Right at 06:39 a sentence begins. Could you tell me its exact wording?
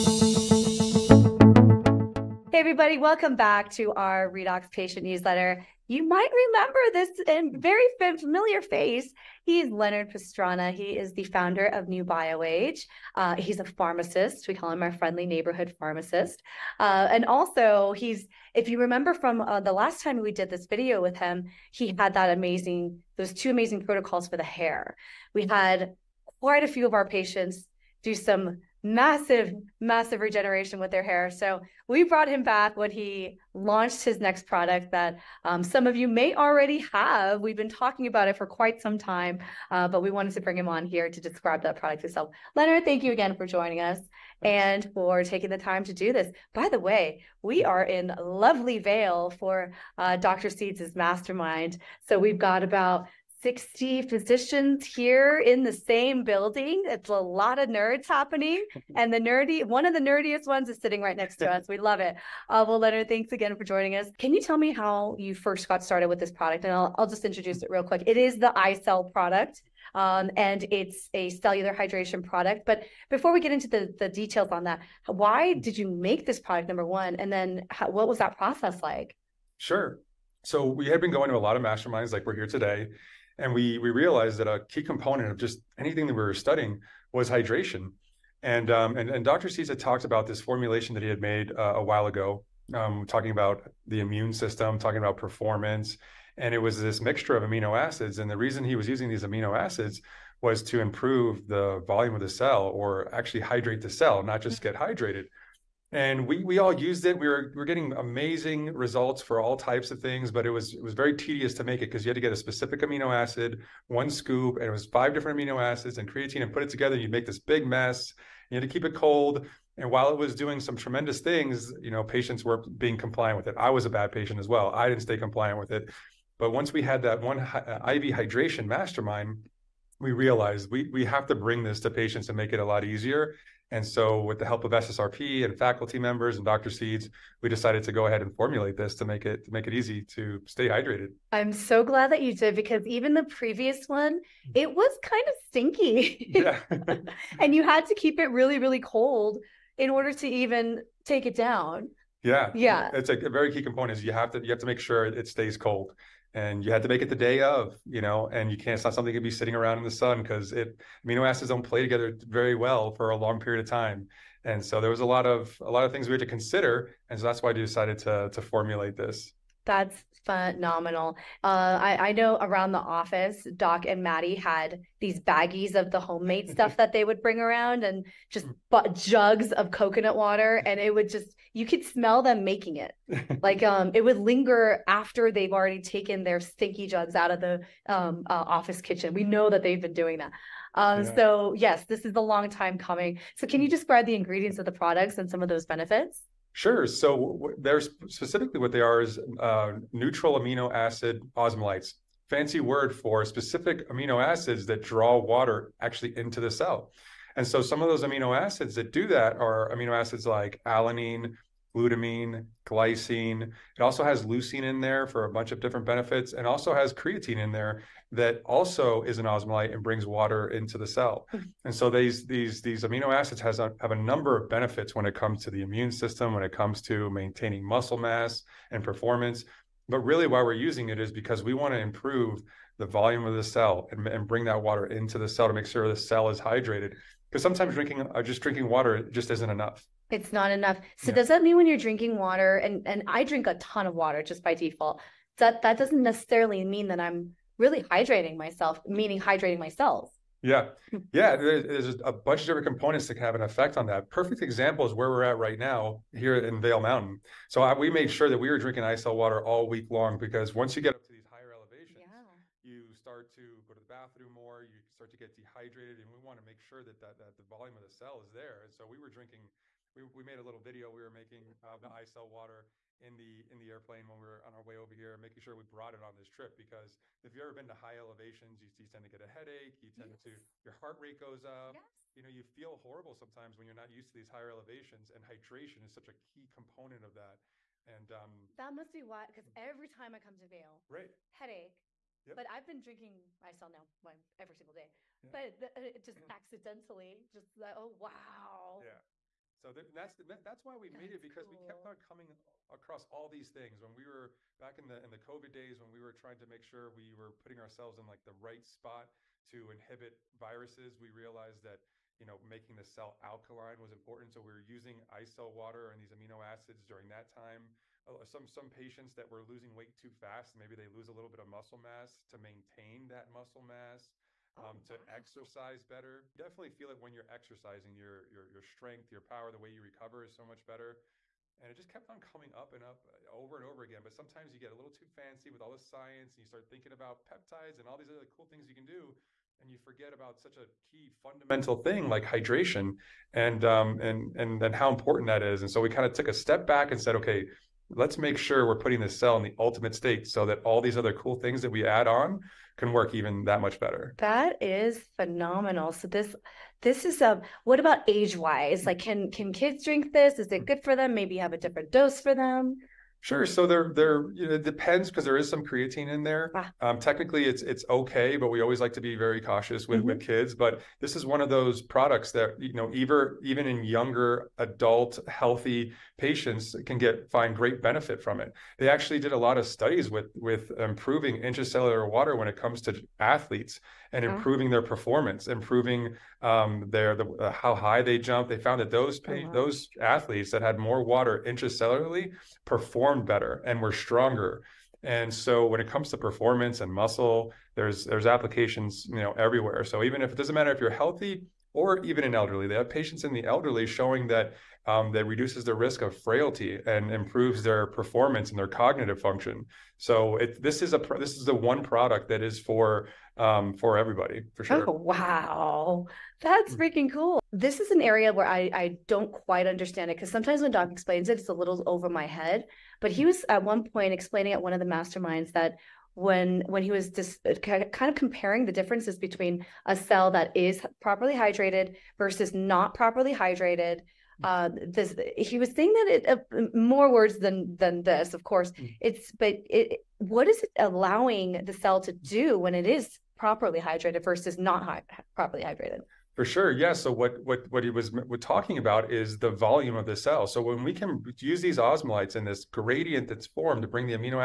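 So even if it doesn't matter if you're healthy or even in elderly.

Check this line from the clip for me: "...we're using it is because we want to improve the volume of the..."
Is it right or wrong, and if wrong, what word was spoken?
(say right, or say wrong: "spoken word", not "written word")
right.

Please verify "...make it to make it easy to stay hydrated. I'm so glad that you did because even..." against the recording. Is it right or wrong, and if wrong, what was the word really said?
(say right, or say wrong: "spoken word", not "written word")
right.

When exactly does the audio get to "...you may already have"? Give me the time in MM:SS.
00:35.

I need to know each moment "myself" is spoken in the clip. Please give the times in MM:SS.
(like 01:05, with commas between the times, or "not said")
04:08, 04:53.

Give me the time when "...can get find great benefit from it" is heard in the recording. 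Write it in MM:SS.
06:16.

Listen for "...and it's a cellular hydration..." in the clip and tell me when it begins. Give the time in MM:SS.
01:10.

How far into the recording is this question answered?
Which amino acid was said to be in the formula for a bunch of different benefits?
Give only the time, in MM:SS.
03:34.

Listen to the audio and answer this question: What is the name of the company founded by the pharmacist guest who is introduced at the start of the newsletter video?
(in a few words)
NuBioAge.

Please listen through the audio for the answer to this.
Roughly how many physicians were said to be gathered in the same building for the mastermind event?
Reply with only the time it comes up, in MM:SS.
00:53.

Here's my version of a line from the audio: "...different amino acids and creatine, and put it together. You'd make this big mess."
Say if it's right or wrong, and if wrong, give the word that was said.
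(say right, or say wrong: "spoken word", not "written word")
right.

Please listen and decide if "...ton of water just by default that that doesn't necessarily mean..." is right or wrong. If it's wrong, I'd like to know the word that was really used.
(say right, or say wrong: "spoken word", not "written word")
right.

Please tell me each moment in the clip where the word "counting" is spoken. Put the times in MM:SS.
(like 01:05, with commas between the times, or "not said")
not said.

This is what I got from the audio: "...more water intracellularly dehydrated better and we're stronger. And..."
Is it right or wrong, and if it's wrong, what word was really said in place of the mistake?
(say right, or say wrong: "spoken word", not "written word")
wrong: "performed", not "dehydrated".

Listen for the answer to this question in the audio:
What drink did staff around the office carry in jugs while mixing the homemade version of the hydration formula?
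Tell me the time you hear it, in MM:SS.
02:59.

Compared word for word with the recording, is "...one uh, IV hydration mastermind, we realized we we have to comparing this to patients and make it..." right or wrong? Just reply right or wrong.
wrong.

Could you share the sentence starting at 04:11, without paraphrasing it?
There's, there's a bunch of different components that can have an effect on that.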